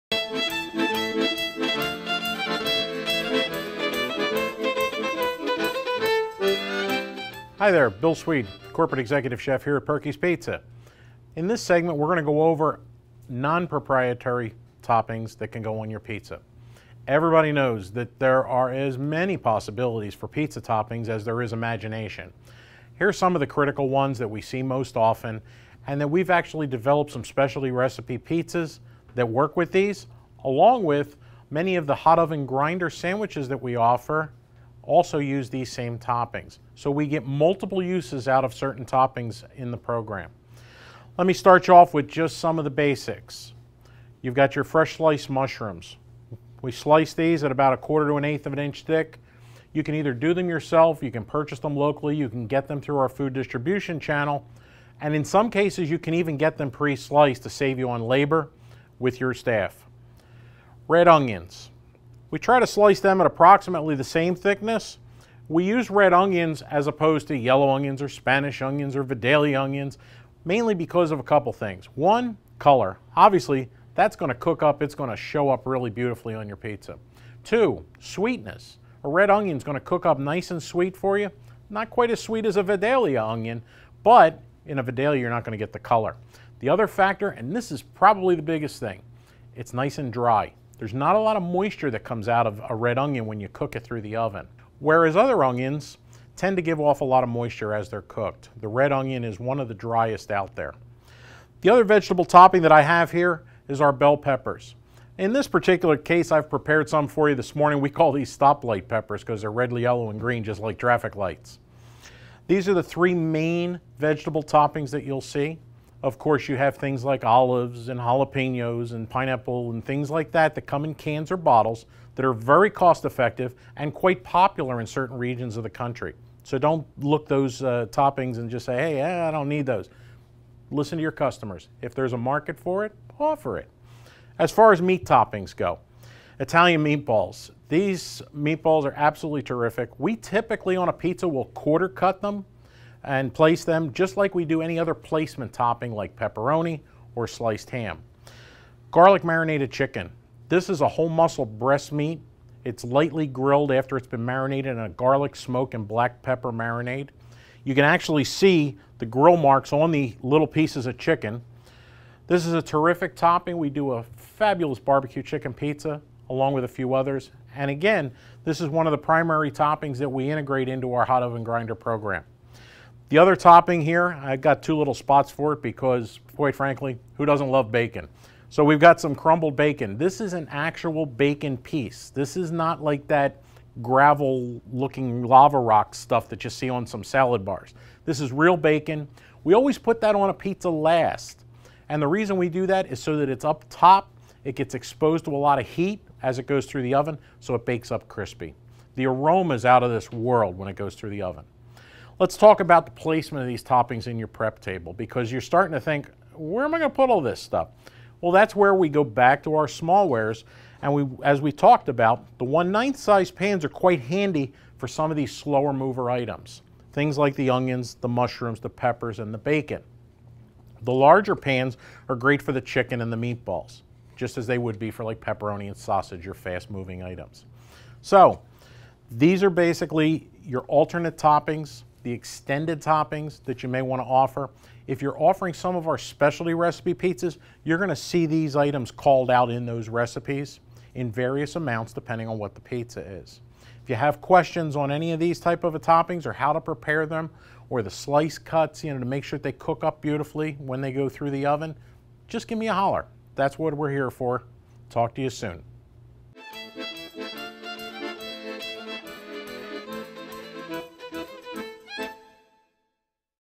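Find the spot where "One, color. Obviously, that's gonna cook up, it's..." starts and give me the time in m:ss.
1:11.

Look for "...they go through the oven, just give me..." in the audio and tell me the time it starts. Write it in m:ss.
4:10.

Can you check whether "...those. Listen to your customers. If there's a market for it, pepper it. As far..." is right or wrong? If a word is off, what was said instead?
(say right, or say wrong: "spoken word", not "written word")
wrong: "offer", not "pepper".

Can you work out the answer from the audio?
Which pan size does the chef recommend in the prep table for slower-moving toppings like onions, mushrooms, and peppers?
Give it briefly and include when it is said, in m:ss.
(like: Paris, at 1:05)
1/9 size pans, at 3:32.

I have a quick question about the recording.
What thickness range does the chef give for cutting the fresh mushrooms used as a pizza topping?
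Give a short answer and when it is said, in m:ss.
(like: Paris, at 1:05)
1/4 to 1/8 inch, at 0:47.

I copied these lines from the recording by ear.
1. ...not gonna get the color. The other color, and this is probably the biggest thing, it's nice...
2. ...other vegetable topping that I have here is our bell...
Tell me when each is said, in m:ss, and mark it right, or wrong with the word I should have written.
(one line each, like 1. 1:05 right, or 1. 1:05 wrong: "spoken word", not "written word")
1. 1:25 wrong: "factor", not "color"
2. 1:41 right.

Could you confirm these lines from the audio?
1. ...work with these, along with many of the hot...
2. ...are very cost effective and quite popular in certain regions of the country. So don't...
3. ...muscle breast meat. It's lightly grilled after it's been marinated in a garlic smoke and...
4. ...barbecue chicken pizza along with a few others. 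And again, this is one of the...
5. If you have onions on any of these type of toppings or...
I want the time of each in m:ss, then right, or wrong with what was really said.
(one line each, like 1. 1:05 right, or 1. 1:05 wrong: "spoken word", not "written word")
1. 0:29 right
2. 2:02 right
3. 2:31 right
4. 2:44 right
5. 4:03 wrong: "questions", not "onions".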